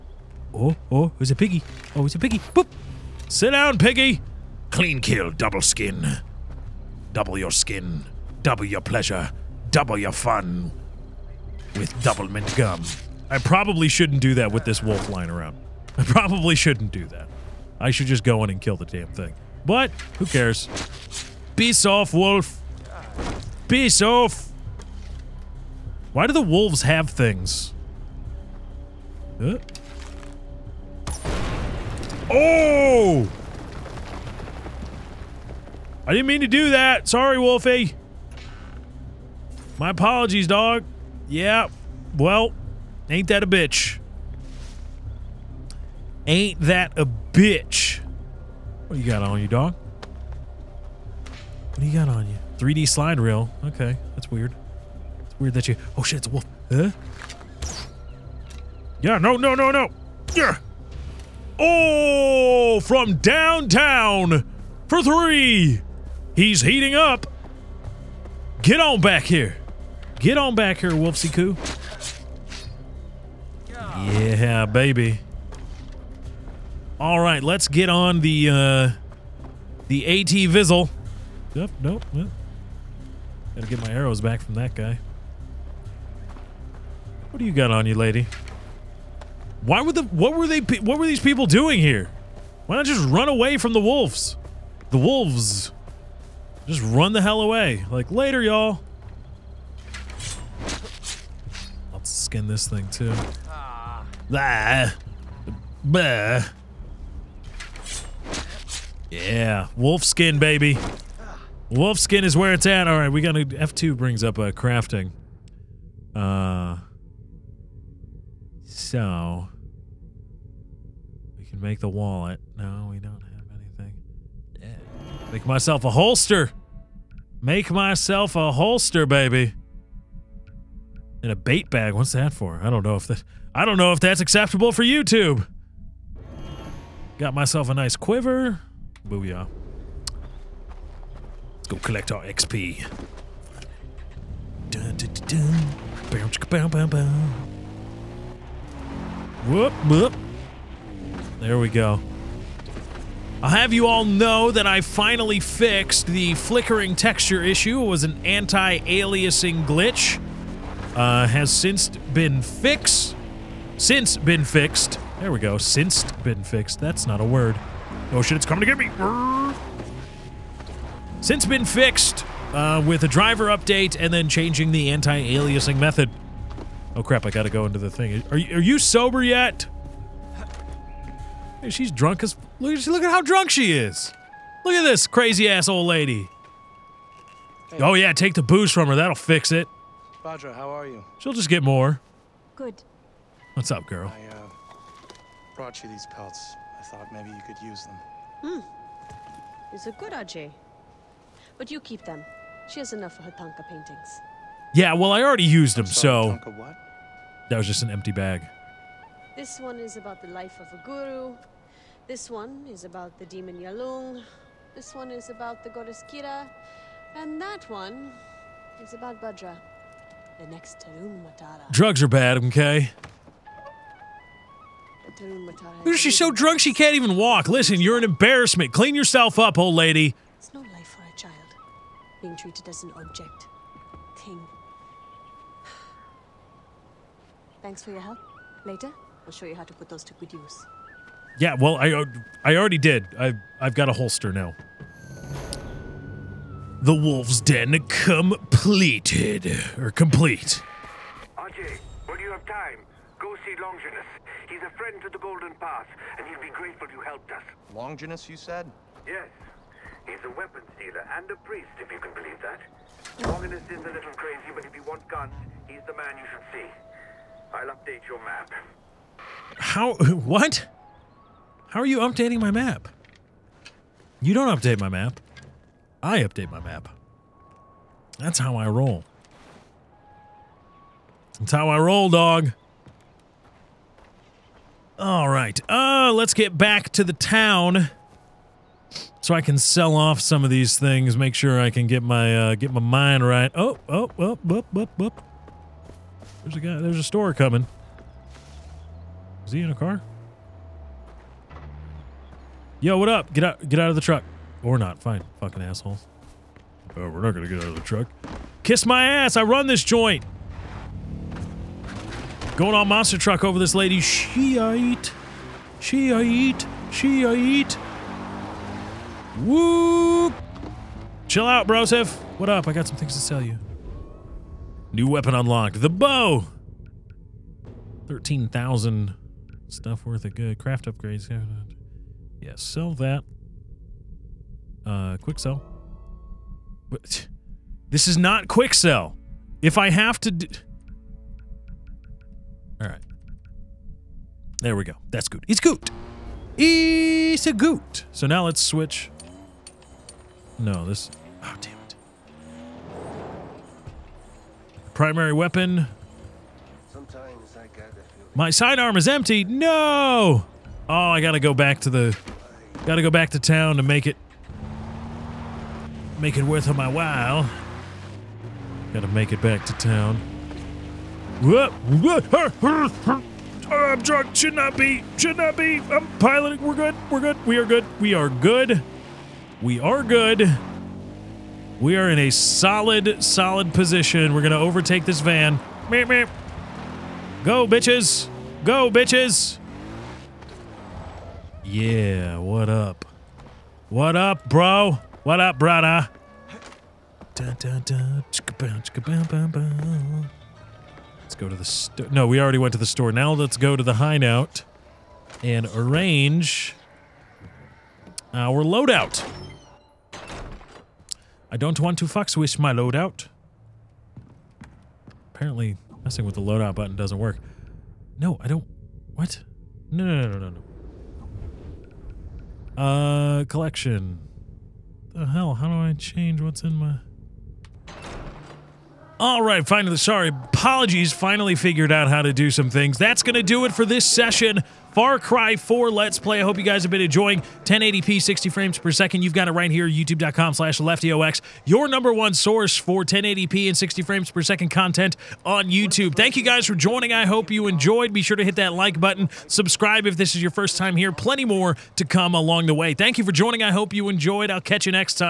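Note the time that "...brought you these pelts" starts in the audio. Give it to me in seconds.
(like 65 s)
195 s.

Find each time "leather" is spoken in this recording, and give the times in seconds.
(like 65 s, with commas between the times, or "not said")
not said.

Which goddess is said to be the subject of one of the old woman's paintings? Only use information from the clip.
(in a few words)
Kyra.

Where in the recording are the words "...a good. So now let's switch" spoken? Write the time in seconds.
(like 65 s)
347 s.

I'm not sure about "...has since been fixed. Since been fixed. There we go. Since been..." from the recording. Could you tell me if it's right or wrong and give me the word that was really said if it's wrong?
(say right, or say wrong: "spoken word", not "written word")
right.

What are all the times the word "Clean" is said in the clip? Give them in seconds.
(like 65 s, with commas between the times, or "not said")
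4 s, 228 s.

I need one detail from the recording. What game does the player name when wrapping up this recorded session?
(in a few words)
Far Cry 4.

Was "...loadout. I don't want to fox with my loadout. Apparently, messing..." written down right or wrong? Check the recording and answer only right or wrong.
right.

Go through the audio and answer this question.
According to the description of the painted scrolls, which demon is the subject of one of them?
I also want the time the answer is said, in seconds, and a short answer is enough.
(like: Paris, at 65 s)
Yalung, at 213 s.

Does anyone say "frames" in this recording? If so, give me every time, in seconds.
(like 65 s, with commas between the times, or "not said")
438 s, 444 s.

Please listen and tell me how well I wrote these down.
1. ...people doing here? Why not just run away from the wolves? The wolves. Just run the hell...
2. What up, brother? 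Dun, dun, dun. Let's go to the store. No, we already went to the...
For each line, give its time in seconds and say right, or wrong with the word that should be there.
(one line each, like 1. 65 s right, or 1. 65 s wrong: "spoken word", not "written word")
1. 91 s right
2. 395 s right.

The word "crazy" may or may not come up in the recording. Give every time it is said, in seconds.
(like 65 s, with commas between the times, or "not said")
185 s, 264 s.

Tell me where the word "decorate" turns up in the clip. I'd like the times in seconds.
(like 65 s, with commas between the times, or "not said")
not said.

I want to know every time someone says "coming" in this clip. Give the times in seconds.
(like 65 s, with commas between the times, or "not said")
168 s, 297 s.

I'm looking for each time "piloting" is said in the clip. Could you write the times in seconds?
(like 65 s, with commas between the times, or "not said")
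376 s.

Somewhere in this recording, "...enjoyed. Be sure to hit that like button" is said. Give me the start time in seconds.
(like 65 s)
447 s.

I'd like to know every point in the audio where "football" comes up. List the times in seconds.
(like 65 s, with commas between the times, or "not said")
not said.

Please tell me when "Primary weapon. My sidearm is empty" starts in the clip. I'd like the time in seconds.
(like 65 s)
354 s.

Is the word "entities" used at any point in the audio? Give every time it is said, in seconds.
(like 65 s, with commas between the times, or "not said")
not said.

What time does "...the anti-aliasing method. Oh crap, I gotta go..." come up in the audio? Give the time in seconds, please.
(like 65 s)
174 s.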